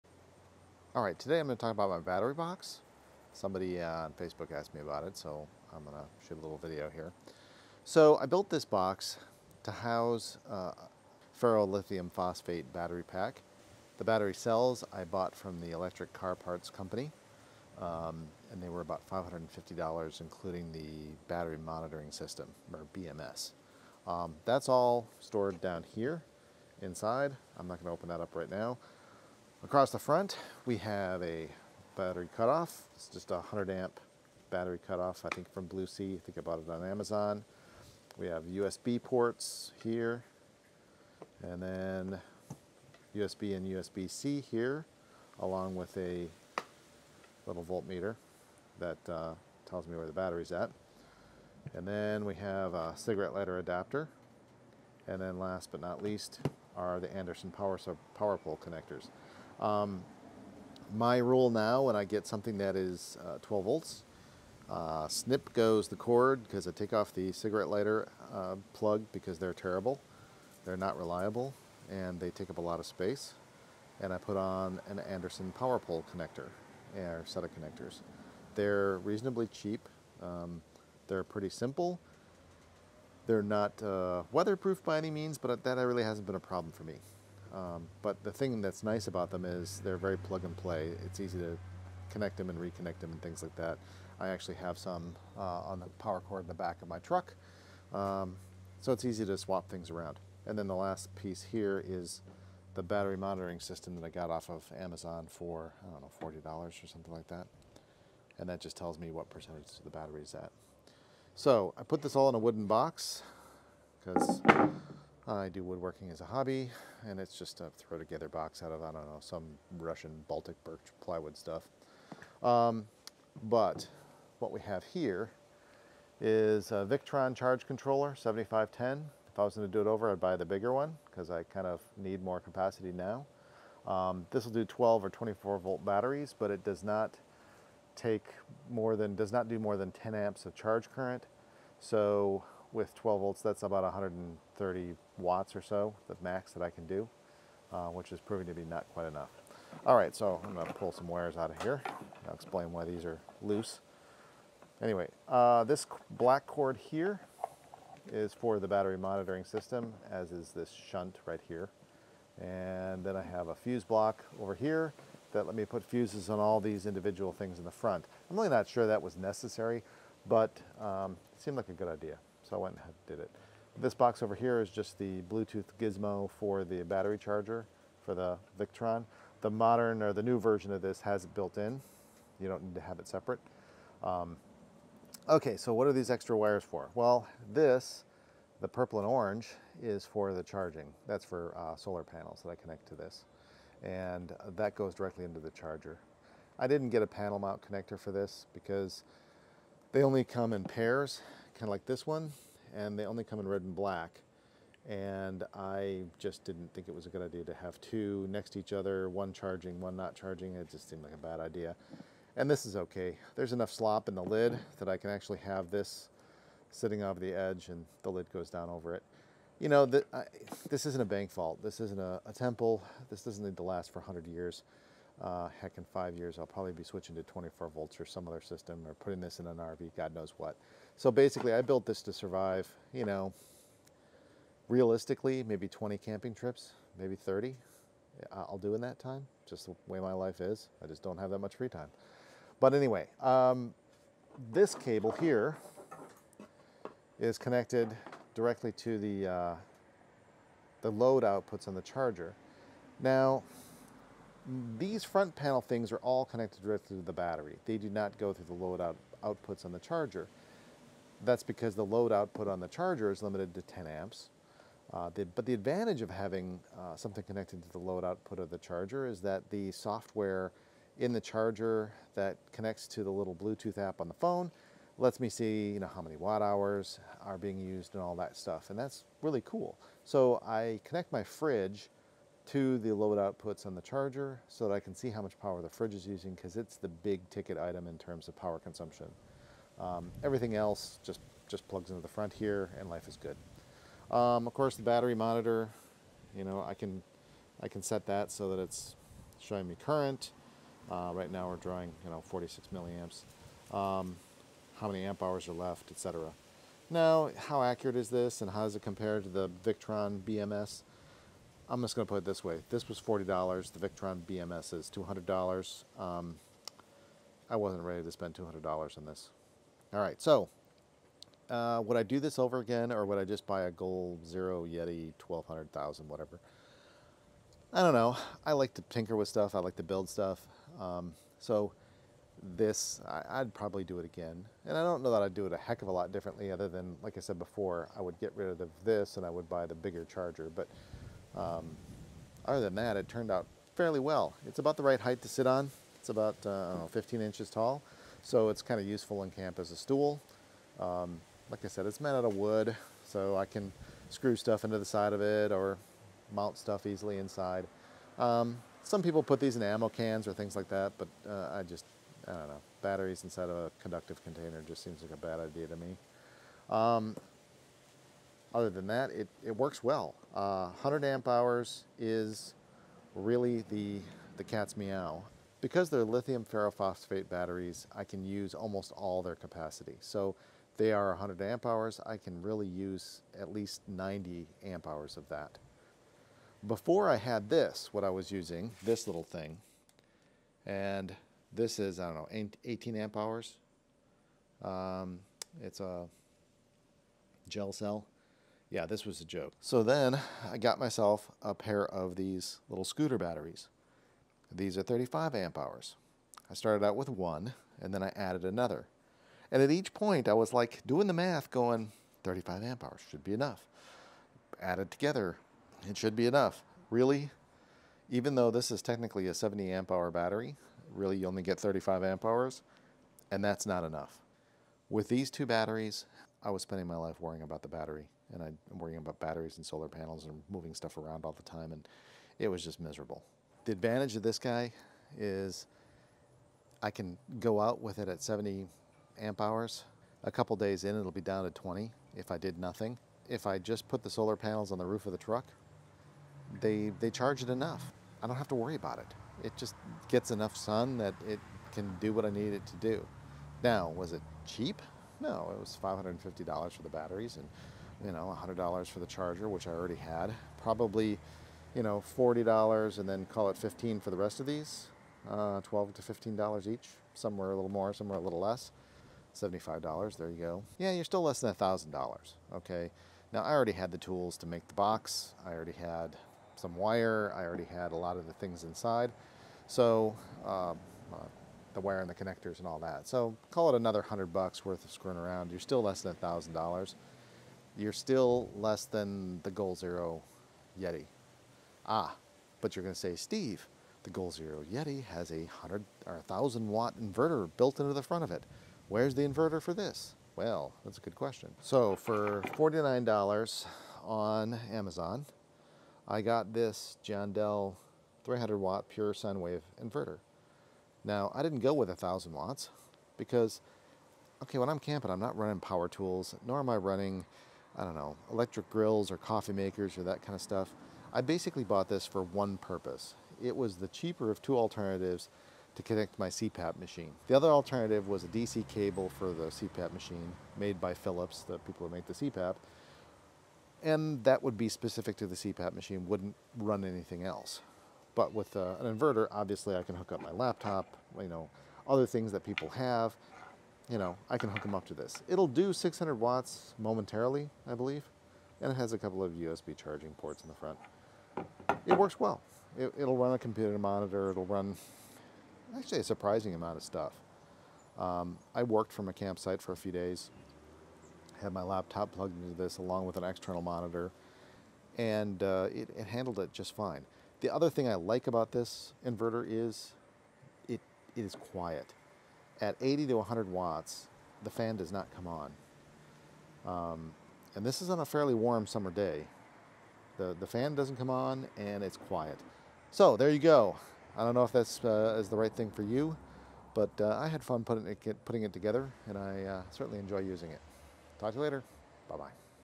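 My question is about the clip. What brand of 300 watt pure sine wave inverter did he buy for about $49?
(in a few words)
Giandel.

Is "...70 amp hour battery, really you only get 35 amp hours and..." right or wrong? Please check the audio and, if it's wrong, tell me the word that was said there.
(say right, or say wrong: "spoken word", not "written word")
right.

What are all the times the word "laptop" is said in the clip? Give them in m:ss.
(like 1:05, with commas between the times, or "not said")
9:00, 9:21.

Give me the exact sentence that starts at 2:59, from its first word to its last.
The modern or the new version of this has it built in.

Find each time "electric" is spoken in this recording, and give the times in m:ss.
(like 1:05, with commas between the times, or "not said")
0:15, 8:38.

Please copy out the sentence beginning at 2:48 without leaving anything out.
I'm really not sure that was necessary, but um, it seemed like a good idea.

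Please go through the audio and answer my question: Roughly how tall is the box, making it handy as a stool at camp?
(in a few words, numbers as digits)
15 inches.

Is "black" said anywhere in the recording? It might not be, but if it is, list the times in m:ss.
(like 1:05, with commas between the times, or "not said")
2:36, 3:23.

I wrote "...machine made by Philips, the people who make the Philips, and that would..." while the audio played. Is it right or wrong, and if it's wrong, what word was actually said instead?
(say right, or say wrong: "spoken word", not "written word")
wrong: "CPAP", not "Philips".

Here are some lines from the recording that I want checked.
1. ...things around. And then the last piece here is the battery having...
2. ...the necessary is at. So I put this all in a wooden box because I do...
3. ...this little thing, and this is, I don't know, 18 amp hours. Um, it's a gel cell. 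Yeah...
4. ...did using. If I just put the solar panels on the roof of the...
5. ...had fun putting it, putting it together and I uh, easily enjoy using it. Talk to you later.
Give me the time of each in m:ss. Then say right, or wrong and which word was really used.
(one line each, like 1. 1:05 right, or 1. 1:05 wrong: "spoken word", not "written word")
1. 1:39 wrong: "monitoring", not "having"
2. 1:49 wrong: "battery", not "necessary"
3. 6:28 right
4. 7:22 wrong: "nothing", not "using"
5. 9:47 wrong: "certainly", not "easily".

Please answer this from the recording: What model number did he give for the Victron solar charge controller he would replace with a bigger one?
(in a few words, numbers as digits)
7510.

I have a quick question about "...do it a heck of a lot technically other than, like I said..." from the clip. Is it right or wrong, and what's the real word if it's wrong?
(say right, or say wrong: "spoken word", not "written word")
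wrong: "differently", not "technically".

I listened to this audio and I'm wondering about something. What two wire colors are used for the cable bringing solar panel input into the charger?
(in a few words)
Purple and orange.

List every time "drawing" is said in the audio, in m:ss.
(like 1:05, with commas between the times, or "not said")
5:01.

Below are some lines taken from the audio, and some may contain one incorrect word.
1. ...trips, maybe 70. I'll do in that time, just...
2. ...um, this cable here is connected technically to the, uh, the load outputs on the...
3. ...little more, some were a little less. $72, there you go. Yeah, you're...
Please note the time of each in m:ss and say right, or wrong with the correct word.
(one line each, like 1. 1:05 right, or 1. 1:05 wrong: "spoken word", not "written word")
1. 3:56 wrong: "30", not "70"
2. 4:03 wrong: "directly", not "technically"
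3. 7:47 wrong: "75", not "72".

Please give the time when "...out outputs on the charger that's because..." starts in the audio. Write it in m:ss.
4:18.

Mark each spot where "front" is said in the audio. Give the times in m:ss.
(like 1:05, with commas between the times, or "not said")
0:29, 2:47, 4:15, 4:52, 8:18, 9:10.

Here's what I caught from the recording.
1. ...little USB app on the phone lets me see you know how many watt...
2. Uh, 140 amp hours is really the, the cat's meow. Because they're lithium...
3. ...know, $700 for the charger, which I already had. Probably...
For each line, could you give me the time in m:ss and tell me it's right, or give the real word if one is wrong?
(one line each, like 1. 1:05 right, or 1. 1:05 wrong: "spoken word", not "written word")
1. 4:33 wrong: "Bluetooth", not "USB"
2. 6:10 wrong: "100", not "140"
3. 7:38 wrong: "100", not "700".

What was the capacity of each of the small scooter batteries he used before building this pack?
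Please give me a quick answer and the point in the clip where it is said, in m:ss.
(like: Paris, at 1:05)
35 amp hours, at 6:44.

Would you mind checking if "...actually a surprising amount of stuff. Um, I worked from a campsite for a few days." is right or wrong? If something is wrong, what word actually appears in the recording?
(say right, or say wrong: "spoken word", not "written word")
right.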